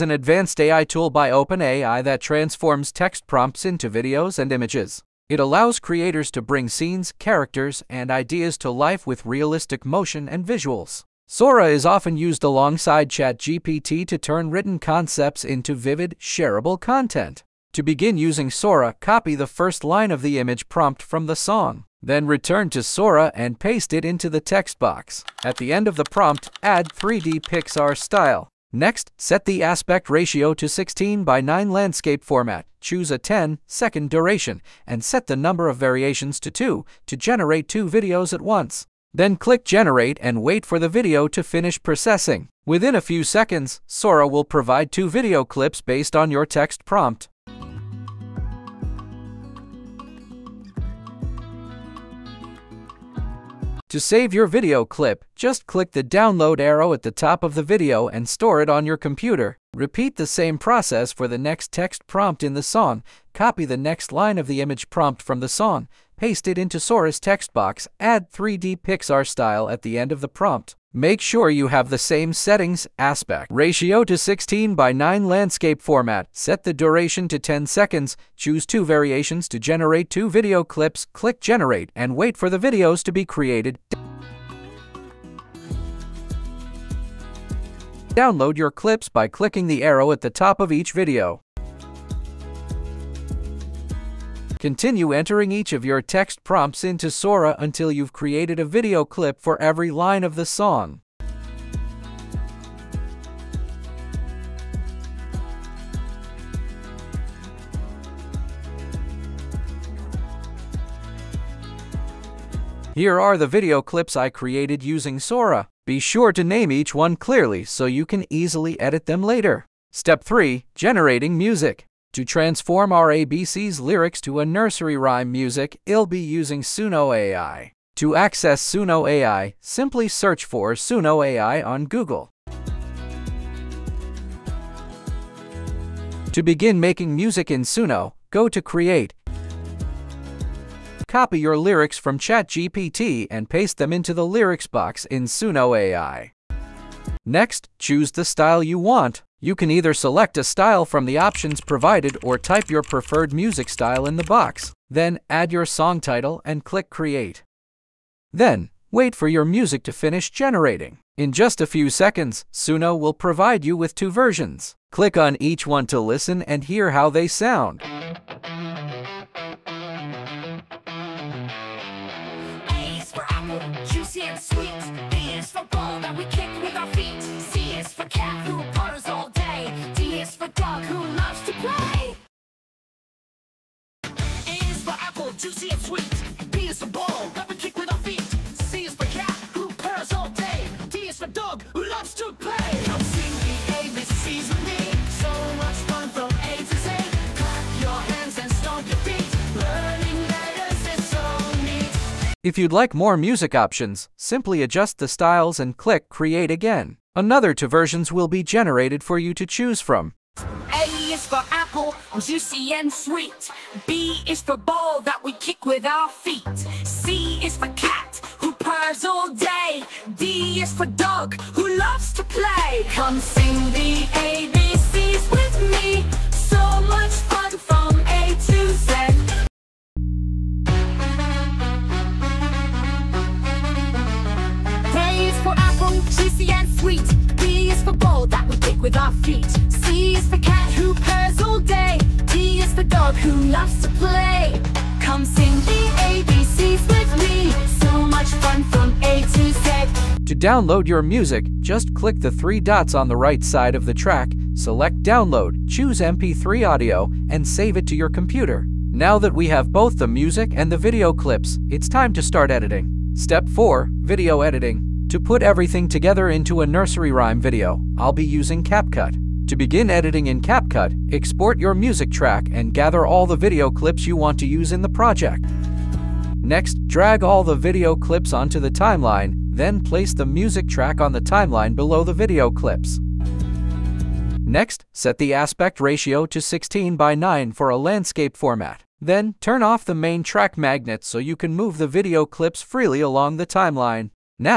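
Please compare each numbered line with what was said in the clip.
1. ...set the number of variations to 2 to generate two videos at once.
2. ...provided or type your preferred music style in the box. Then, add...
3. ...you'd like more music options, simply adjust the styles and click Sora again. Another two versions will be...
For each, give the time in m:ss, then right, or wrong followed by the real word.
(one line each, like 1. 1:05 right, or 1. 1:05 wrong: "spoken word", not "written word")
1. 0:35 right
2. 2:31 right
3. 3:22 wrong: "Create", not "Sora".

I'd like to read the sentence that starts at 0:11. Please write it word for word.
Sora is often used alongside ChatGPT to turn written concepts into vivid, shareable content.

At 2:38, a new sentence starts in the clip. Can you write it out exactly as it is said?
Then, wait for your music to finish generating.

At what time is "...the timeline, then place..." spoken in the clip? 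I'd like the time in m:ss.
4:38.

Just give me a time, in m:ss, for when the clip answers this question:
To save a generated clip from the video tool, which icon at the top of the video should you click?
0:56.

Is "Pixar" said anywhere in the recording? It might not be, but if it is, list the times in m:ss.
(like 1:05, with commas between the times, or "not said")
0:27, 1:08.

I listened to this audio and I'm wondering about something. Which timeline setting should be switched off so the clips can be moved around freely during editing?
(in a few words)
main track magnet.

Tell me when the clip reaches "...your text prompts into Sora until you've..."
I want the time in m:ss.
1:35.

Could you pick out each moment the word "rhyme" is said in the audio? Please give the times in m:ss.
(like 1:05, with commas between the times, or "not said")
2:04, 4:27.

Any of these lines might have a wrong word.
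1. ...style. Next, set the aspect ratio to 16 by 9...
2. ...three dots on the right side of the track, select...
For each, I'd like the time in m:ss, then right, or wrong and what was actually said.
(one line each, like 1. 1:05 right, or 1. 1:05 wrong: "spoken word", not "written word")
1. 0:27 right
2. 4:12 right.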